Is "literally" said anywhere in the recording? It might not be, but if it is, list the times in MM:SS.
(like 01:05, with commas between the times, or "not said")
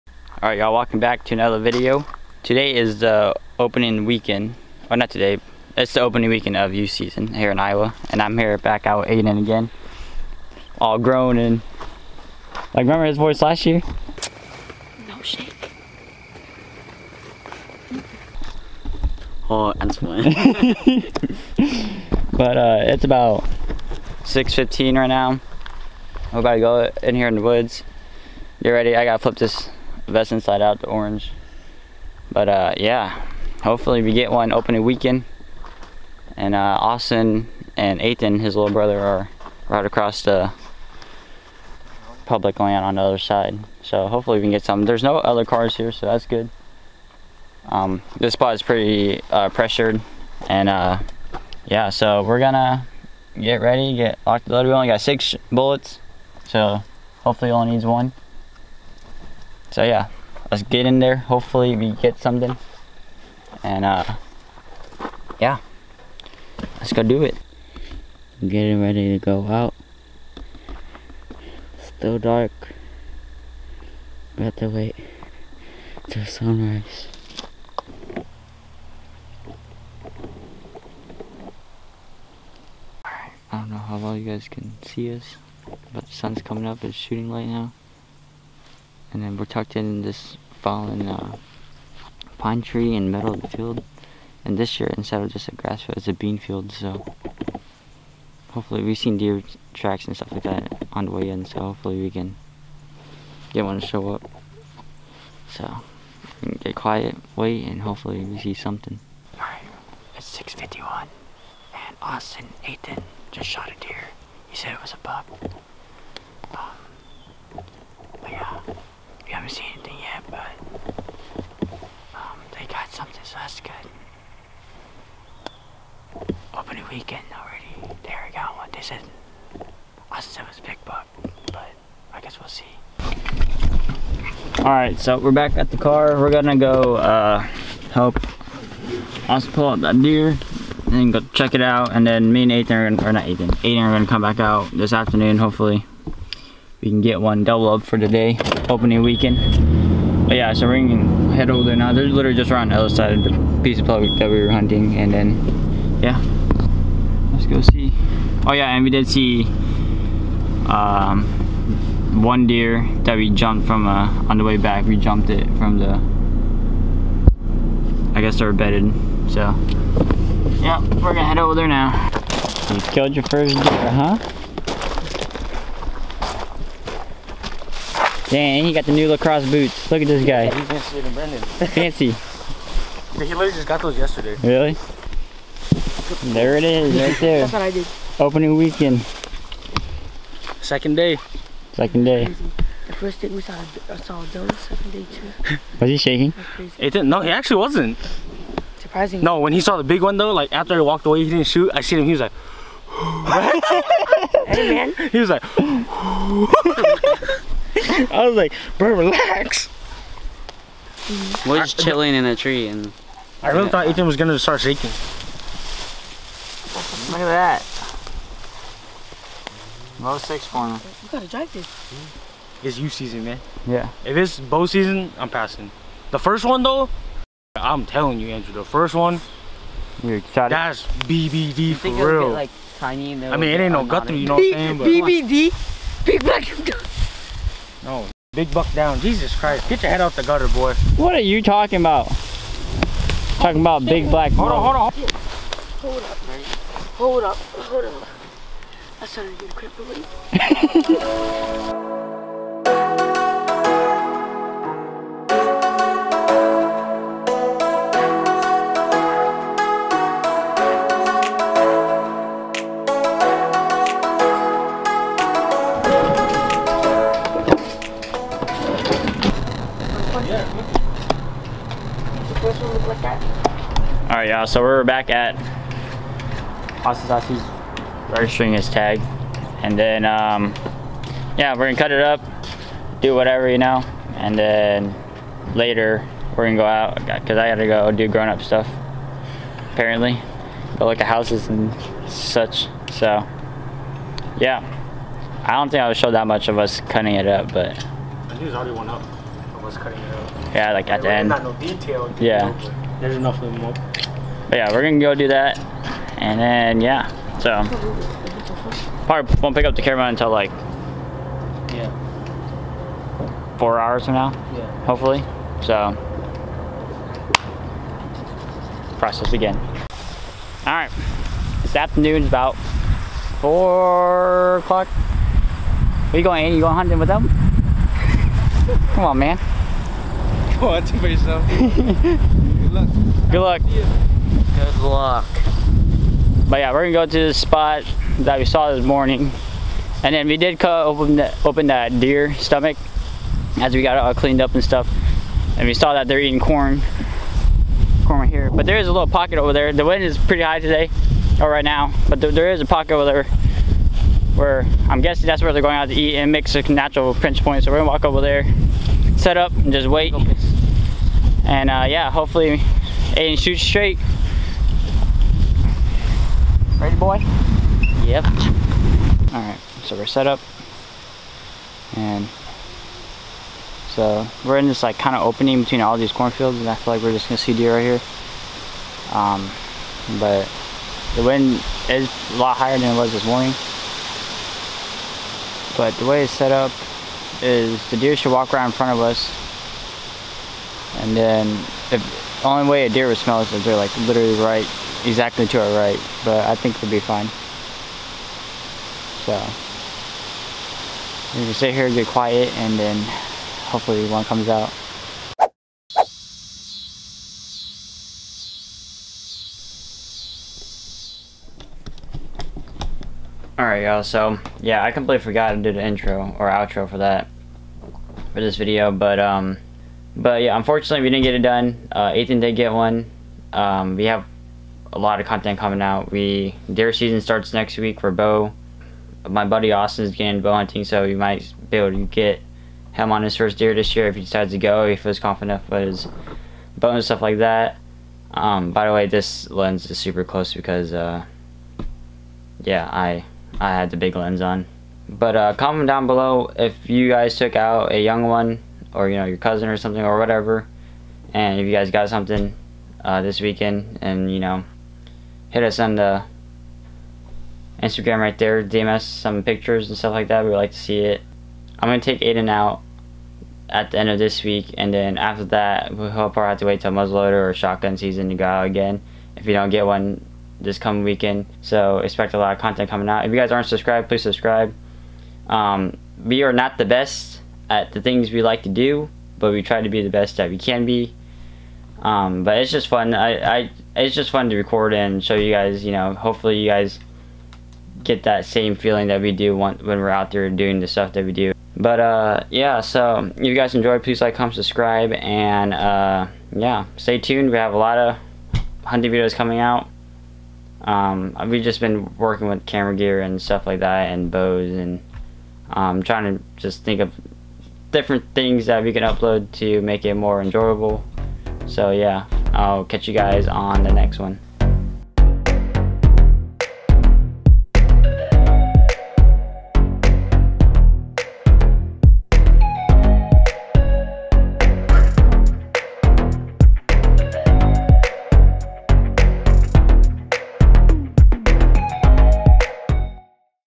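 02:32, 03:03, 06:34.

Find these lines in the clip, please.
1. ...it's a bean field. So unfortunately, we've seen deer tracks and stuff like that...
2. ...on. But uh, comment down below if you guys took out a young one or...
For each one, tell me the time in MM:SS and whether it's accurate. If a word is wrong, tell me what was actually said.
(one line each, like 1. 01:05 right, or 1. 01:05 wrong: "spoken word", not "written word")
1. 01:35 wrong: "hopefully", not "unfortunately"
2. 07:24 right.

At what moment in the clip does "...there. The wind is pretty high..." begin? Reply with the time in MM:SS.
05:49.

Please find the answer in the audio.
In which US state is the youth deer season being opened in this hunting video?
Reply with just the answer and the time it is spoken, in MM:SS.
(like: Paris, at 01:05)
Iowa, at 00:07.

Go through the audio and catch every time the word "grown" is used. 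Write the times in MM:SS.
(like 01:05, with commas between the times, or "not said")
00:10, 04:48.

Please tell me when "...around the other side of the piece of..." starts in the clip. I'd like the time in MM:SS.
02:32.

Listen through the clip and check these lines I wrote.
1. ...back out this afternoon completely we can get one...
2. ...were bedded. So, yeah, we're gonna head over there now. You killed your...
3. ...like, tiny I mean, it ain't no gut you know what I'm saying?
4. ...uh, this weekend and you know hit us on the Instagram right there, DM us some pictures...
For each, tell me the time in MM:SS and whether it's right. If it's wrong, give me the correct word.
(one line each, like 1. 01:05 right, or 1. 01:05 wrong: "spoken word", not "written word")
1. 02:24 wrong: "hopefully", not "completely"
2. 02:48 right
3. 03:52 right
4. 07:33 right.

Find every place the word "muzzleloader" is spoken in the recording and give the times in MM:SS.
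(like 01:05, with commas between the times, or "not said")
07:46.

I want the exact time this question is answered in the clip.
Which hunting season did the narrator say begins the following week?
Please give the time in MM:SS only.
07:07.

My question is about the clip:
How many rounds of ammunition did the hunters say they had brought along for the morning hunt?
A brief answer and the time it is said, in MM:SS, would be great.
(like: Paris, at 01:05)
6, at 00:55.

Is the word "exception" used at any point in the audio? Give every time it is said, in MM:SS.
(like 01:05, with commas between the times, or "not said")
not said.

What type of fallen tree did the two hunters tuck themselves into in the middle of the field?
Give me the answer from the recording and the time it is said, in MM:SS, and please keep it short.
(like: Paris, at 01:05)
Pine tree, at 01:32.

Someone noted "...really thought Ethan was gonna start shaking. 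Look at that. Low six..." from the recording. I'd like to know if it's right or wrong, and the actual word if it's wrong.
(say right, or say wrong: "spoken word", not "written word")
right.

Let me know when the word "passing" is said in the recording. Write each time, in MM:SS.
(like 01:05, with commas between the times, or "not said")
03:45.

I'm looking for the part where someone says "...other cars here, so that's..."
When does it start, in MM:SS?
00:45.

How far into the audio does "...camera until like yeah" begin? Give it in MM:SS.
05:09.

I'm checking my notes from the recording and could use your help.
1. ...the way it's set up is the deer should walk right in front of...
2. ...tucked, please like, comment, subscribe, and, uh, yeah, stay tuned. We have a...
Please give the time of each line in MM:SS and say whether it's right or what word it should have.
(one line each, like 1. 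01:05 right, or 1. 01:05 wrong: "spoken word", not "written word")
1. 06:26 right
2. 08:13 wrong: "enjoyed", not "tucked".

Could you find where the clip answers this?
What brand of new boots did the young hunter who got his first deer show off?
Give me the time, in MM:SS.
02:59.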